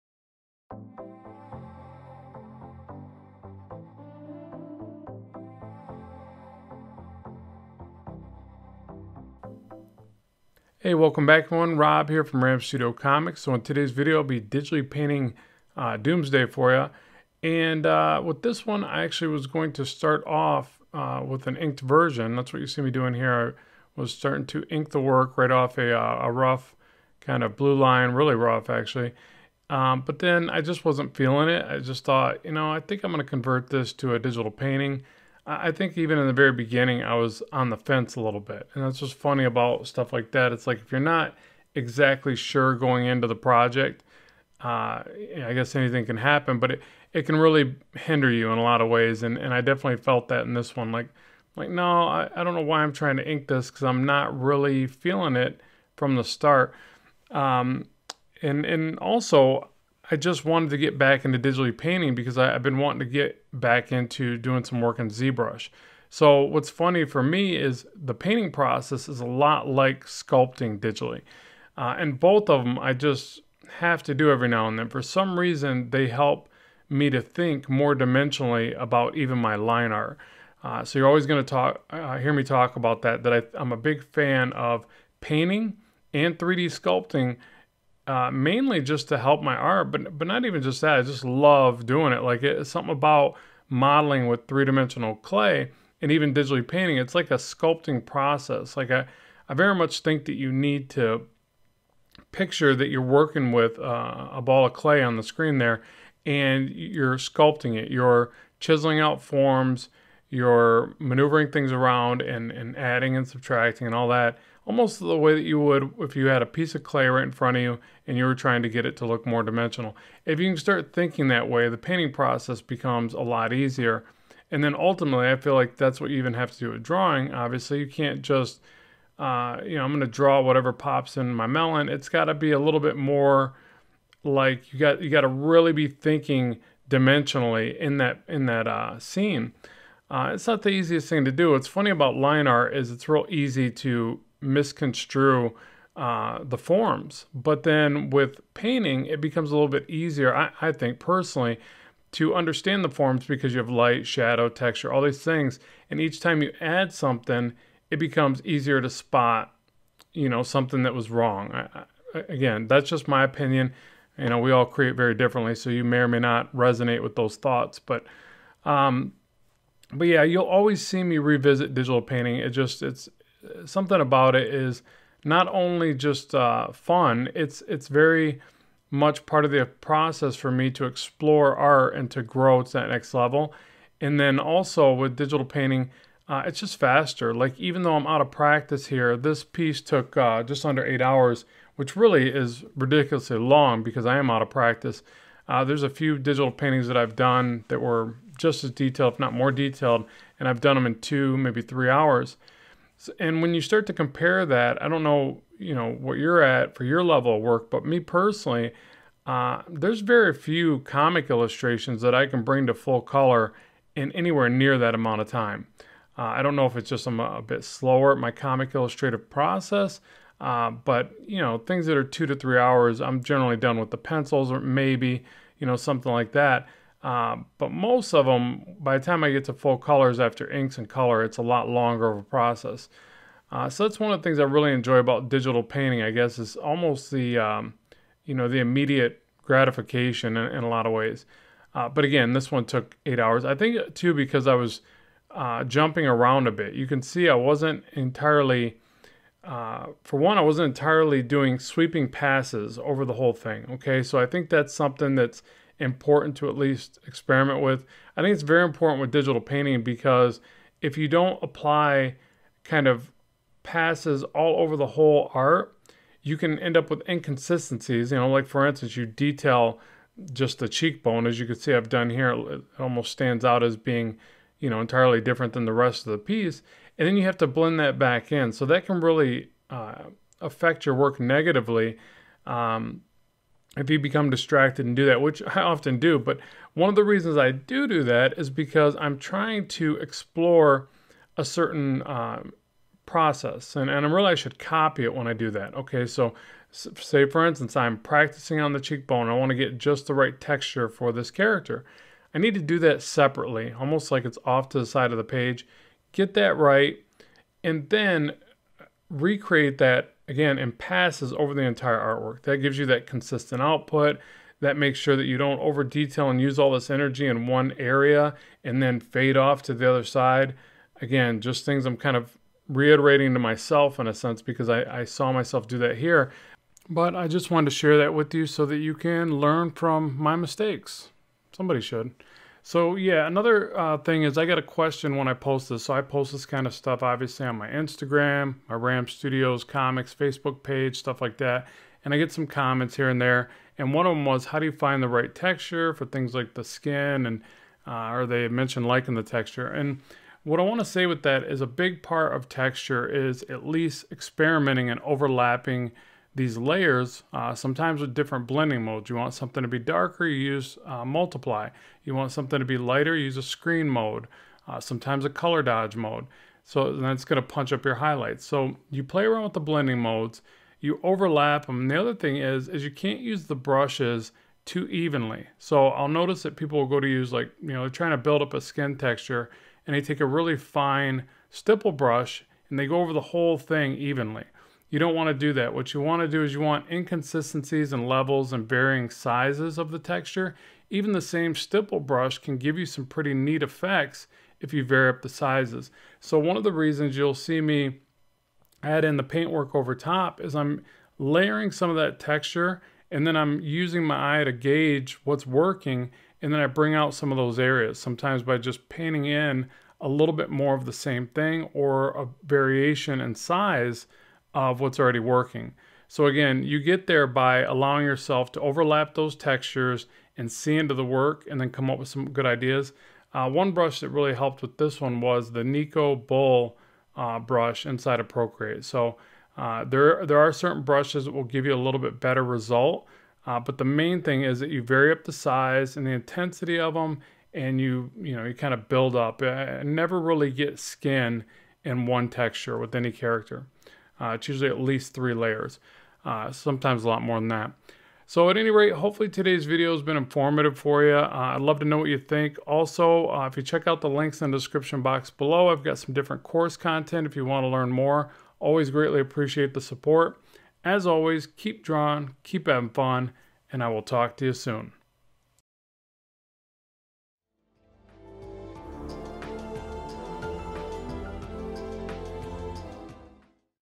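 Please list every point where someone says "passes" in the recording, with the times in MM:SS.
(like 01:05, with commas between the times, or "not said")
04:12, 04:23, 05:10.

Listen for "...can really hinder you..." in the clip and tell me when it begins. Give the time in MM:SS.
00:47.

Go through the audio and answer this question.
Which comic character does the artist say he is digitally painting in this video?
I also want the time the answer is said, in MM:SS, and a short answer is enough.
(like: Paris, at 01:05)
Doomsday, at 00:15.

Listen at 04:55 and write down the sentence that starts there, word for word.
Okay, so say for instance I'm practicing on the cheekbone, I want to get just the right texture for this character.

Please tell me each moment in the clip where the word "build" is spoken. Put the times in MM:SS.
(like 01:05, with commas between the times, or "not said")
06:18, 07:18.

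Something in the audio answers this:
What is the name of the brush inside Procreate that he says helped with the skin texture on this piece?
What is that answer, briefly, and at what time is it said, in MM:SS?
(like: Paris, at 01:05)
Nikko Rull, at 07:05.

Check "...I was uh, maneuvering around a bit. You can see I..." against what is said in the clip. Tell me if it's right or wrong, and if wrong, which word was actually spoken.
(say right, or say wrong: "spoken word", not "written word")
wrong: "jumping", not "maneuvering".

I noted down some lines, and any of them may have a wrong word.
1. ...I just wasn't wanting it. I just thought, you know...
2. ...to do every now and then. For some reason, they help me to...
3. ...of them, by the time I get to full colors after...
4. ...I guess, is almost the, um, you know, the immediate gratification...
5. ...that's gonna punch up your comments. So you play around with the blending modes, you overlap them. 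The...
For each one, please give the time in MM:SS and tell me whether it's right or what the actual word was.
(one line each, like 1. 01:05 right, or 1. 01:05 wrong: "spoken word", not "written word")
1. 00:30 wrong: "feeling", not "wanting"
2. 01:14 right
3. 03:48 right
4. 03:56 right
5. 06:06 wrong: "highlights", not "comments".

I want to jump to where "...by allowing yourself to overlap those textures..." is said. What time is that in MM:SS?
06:57.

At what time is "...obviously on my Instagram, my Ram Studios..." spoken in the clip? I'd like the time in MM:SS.
05:37.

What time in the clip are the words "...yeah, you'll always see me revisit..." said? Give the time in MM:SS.
02:50.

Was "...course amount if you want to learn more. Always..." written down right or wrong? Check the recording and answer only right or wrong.
wrong.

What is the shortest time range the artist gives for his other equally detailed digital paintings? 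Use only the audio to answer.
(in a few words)
2 to 3 hours.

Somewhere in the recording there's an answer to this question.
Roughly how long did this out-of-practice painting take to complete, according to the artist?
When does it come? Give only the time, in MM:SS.
03:10.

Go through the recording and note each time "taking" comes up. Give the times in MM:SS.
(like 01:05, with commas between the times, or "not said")
not said.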